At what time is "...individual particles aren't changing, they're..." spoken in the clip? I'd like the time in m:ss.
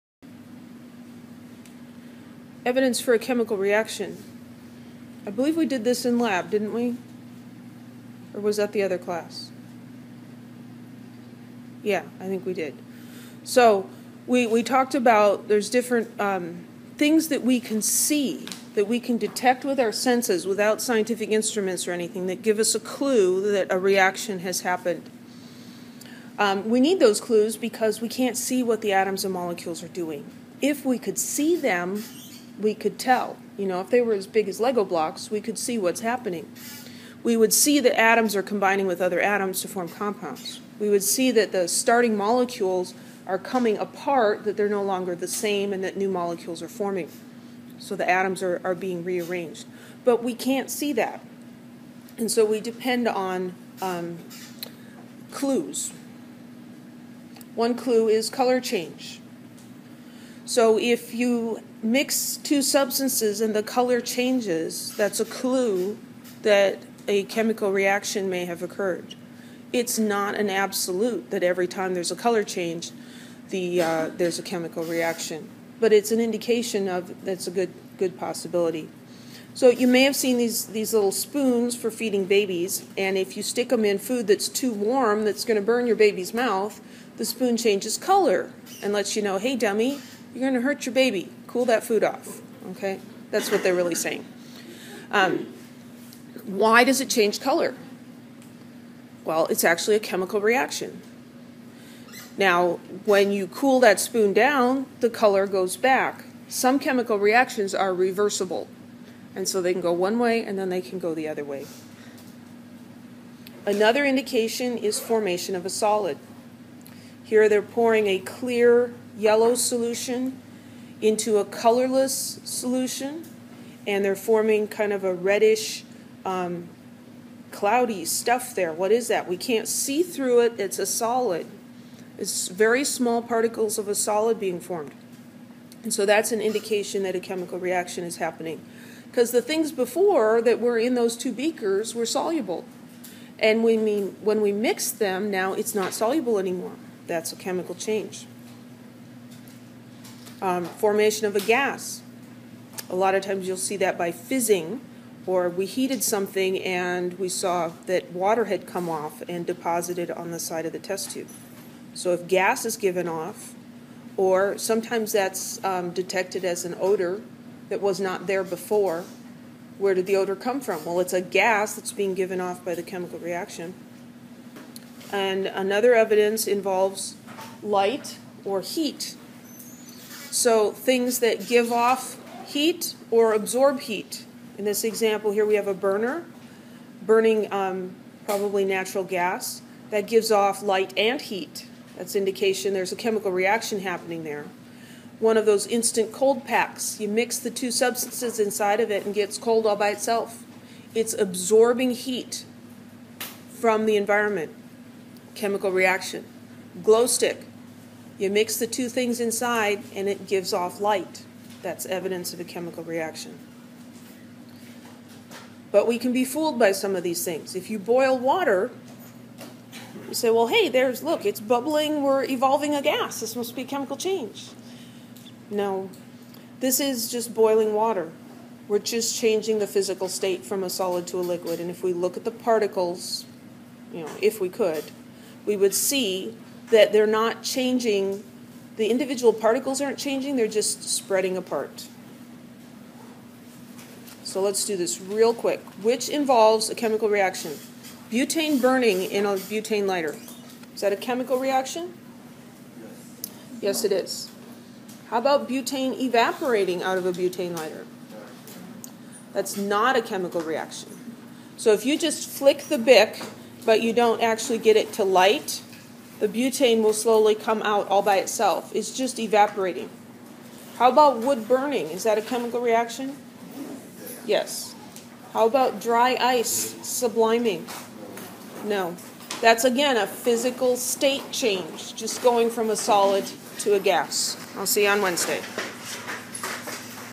3:58.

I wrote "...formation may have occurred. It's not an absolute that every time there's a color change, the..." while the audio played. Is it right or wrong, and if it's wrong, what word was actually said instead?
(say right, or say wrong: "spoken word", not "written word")
wrong: "reaction", not "formation".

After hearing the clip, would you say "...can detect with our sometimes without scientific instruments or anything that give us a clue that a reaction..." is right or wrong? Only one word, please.
wrong.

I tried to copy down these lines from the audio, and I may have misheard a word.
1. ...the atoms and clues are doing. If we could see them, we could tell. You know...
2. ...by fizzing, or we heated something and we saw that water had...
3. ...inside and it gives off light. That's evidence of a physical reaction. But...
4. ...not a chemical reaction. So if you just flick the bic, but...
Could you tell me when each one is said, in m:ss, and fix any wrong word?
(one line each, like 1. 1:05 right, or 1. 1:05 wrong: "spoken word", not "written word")
1. 0:28 wrong: "molecules", not "clues"
2. 2:33 right
3. 3:29 wrong: "chemical", not "physical"
4. 4:19 right.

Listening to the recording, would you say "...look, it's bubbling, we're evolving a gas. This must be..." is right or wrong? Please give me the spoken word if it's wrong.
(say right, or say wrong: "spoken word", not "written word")
right.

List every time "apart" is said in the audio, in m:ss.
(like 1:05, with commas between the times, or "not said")
0:43, 4:01.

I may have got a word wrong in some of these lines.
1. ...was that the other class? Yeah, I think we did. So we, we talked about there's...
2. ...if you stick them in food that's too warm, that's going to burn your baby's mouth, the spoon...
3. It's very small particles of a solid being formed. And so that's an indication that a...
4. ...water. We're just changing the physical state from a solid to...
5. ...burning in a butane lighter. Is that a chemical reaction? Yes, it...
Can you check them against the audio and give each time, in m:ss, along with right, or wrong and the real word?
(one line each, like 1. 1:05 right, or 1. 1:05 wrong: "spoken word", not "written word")
1. 0:08 right
2. 1:23 right
3. 2:12 right
4. 3:47 right
5. 4:08 right.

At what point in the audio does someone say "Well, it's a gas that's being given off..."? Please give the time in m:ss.
2:50.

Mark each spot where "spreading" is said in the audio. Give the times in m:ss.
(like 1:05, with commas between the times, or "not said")
4:00.